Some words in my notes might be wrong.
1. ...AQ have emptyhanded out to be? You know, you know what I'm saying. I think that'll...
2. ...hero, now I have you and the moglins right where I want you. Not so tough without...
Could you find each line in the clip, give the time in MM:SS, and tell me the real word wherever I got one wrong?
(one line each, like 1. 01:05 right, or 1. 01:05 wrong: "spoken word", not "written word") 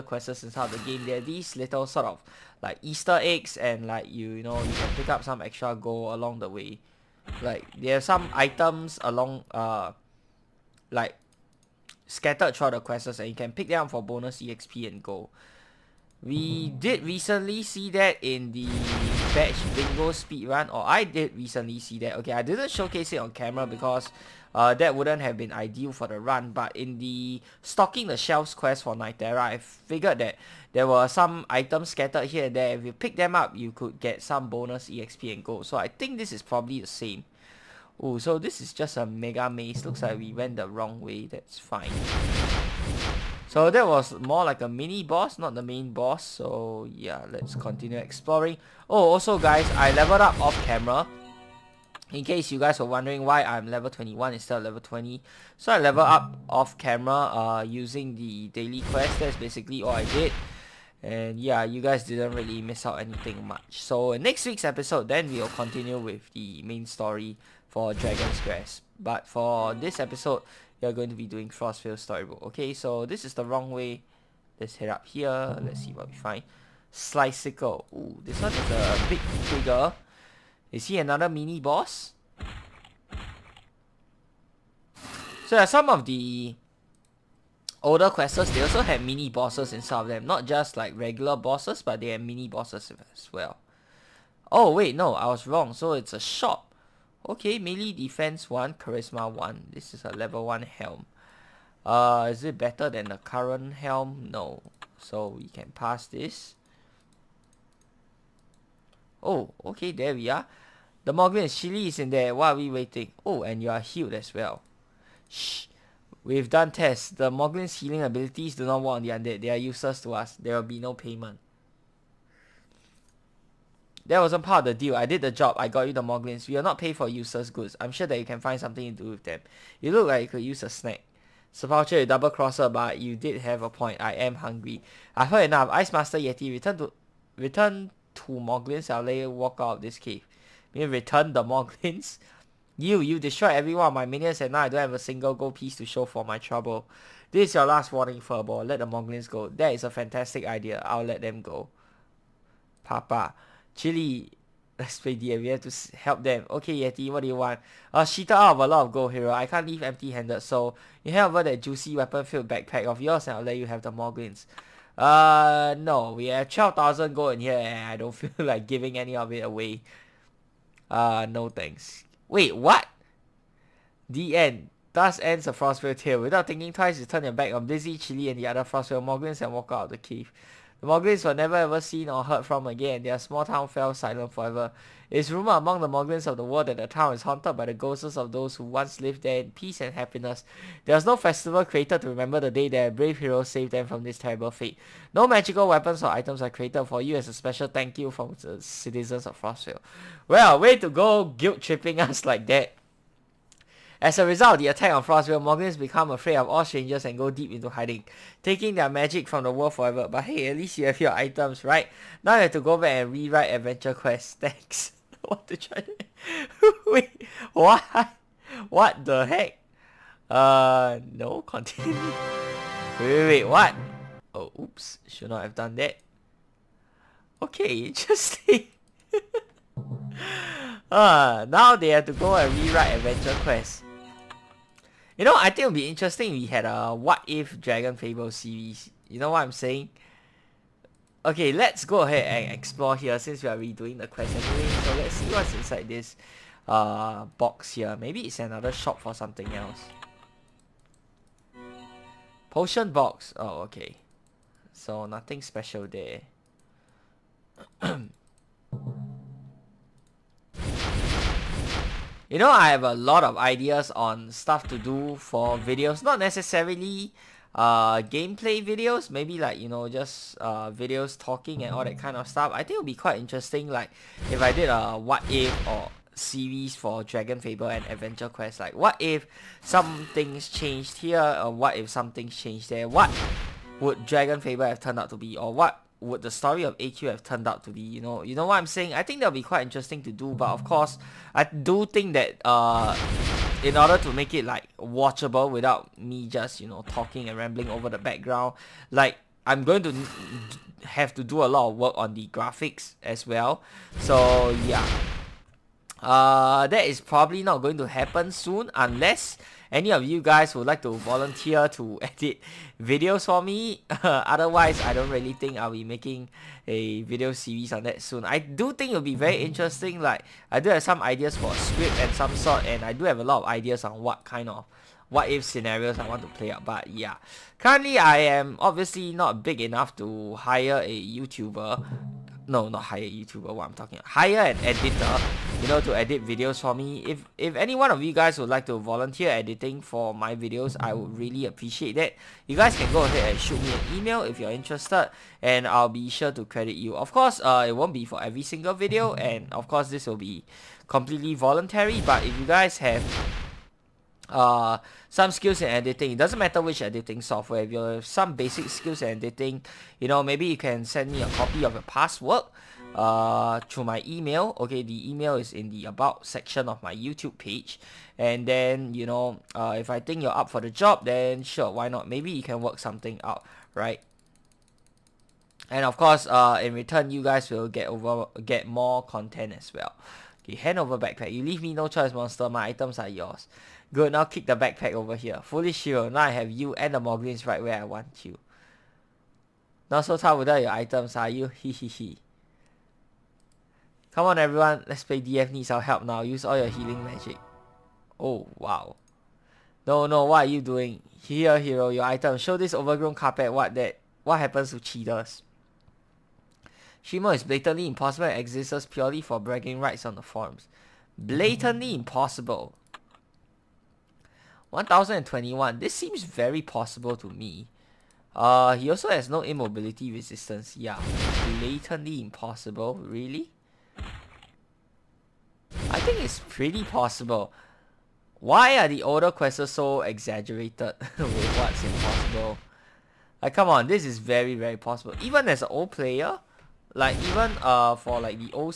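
1. 04:46 wrong: "turned", not "emptyhanded"
2. 06:25 right.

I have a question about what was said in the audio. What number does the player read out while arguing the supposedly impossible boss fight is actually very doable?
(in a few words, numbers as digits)
1021.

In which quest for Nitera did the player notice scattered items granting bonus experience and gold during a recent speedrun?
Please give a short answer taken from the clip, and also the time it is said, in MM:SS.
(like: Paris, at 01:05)
Stocking the shelves, at 00:27.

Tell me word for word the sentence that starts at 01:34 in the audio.
Oh wait, no, I was wrong.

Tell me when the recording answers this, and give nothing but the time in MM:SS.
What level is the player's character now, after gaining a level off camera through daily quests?
00:53.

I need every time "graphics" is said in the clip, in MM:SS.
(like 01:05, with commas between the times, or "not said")
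05:02.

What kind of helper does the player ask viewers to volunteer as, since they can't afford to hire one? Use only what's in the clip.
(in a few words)
Editor.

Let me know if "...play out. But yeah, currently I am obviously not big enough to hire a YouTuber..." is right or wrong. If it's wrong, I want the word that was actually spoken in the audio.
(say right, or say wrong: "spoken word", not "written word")
right.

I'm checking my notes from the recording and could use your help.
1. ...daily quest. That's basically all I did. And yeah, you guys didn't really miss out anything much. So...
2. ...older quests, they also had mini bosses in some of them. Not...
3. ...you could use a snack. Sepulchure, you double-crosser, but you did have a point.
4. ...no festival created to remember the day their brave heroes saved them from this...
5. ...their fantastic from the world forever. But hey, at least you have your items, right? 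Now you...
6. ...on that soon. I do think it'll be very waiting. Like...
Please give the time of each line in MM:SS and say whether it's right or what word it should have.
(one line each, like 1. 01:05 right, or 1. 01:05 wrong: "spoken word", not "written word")
1. 00:58 right
2. 01:27 right
3. 02:10 right
4. 03:11 right
5. 03:28 wrong: "magic", not "fantastic"
6. 05:17 wrong: "interesting", not "waiting".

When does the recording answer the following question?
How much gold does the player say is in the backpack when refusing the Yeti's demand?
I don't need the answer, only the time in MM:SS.
02:46.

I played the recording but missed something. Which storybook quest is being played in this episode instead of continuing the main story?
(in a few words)
Frostvale Storybook.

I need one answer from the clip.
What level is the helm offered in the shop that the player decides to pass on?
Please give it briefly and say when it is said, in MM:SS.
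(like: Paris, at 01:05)
1, at 01:40.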